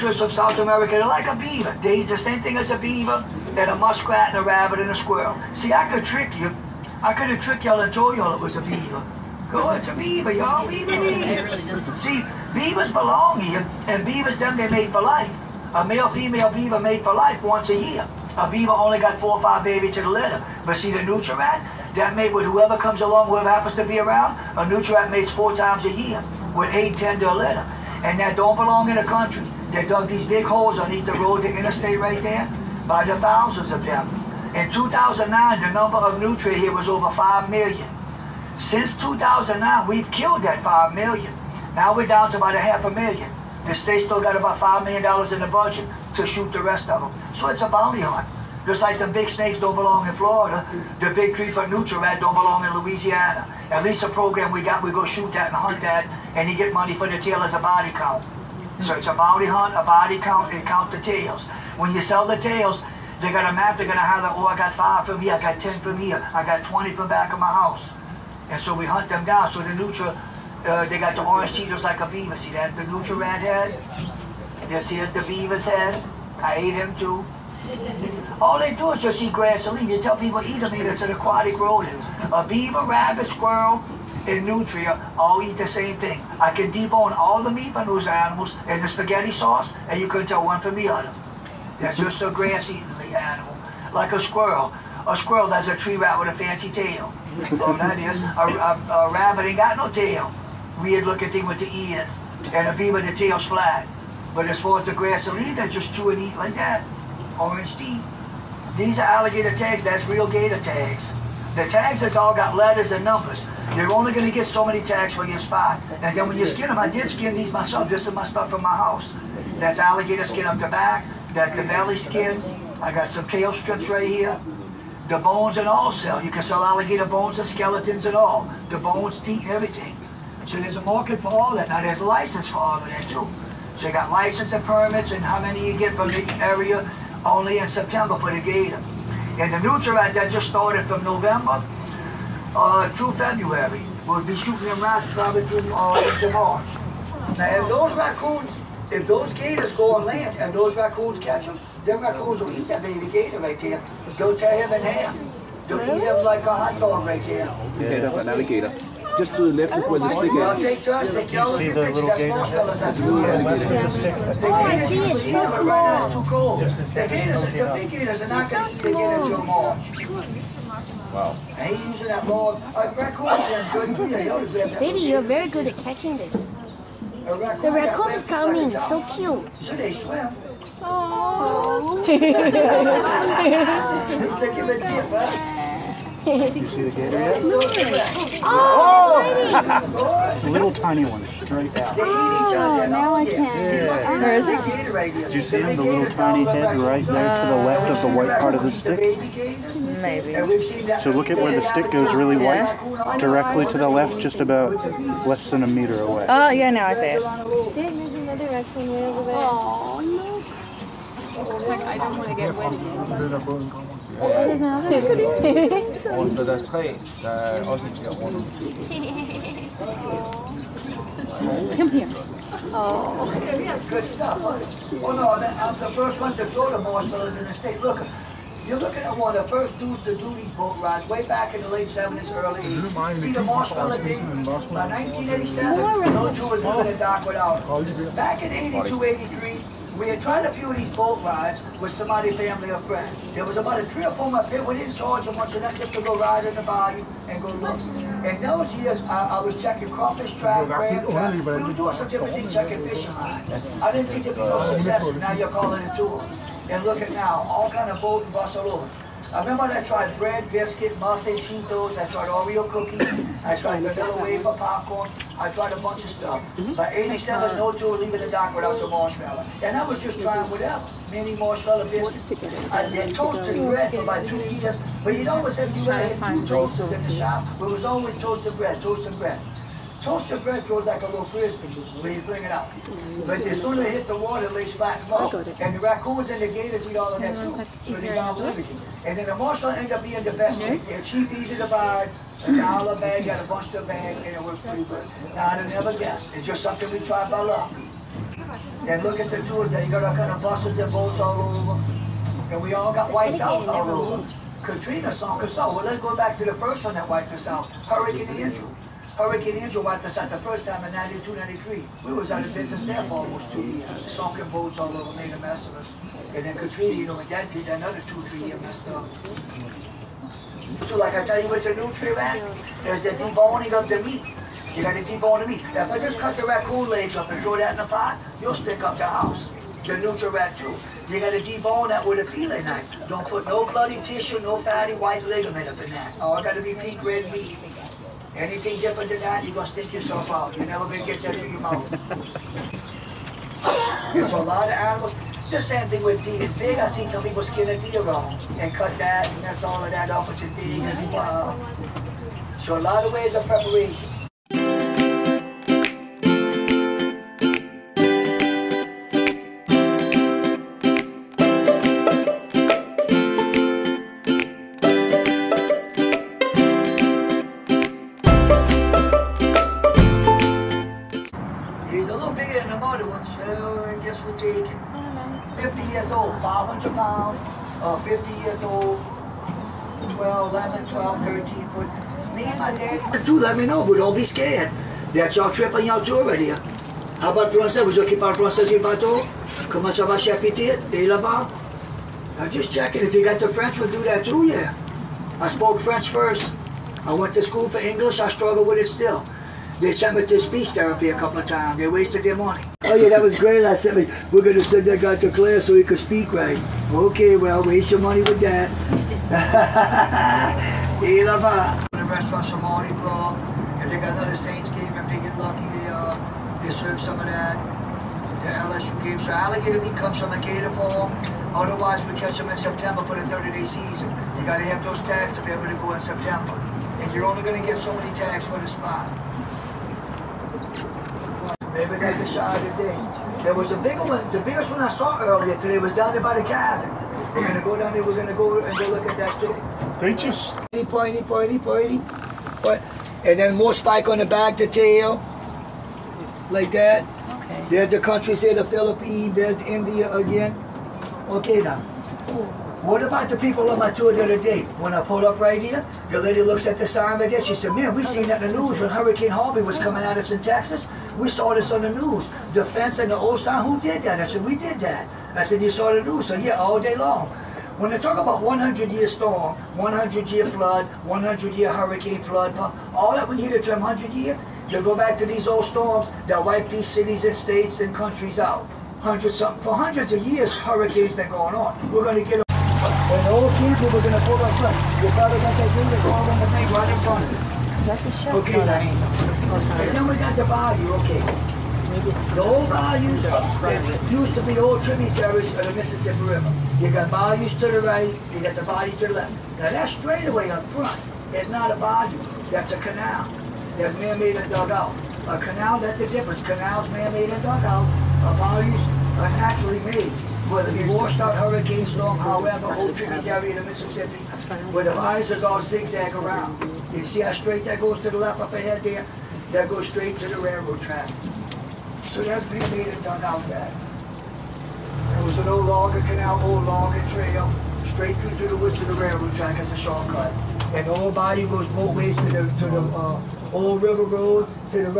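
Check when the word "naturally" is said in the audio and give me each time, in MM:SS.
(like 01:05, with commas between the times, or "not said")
08:29.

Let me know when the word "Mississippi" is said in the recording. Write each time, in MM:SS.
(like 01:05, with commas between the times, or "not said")
08:15, 08:33.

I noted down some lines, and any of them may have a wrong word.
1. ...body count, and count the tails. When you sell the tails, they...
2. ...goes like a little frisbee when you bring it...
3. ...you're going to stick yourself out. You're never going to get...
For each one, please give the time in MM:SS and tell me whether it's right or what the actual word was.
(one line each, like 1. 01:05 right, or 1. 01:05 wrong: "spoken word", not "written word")
1. 00:59 right
2. 04:40 right
3. 05:39 right.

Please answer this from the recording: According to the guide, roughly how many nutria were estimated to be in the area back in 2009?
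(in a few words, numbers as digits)
over 5 million.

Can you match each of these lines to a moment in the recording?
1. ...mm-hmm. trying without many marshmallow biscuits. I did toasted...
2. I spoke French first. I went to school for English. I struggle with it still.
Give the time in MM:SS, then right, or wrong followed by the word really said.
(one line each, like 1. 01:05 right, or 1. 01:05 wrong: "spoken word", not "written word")
1. 04:30 right
2. 06:35 right.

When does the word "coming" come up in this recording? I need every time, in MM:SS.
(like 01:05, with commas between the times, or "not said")
02:58, 07:39.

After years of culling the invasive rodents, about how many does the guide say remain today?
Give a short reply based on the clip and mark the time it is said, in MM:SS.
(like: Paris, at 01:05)
about a half a million, at 00:42.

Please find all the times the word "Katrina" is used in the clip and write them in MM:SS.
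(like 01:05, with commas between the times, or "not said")
05:04, 05:16.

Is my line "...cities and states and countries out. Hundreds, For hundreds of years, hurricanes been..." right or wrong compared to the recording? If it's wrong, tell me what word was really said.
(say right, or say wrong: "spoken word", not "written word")
right.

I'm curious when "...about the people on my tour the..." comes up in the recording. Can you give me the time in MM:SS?
07:33.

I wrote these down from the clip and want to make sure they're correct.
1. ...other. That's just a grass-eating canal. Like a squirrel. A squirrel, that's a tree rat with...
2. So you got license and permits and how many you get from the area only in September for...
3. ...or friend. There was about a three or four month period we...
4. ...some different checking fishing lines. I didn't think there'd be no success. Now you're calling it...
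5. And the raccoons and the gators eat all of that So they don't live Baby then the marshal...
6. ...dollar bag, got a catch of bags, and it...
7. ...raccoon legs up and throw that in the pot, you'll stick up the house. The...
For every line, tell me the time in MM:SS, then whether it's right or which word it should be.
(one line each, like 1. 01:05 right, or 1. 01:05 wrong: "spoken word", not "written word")
1. 01:30 wrong: "animal", not "canal"
2. 02:13 right
3. 04:02 right
4. 04:11 right
5. 04:45 wrong: "And", not "Baby"
6. 04:52 wrong: "bunch", not "catch"
7. 05:26 right.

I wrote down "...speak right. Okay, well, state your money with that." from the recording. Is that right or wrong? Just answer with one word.
wrong.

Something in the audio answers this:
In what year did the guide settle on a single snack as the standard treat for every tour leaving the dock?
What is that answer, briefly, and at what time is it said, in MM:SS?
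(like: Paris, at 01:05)
1987, at 04:26.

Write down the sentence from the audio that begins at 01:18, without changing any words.
All they do is just eat grass and leave.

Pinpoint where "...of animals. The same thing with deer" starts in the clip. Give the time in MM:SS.
05:44.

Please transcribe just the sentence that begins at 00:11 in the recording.
See, beavers belong here, and beavers, them, they made for life.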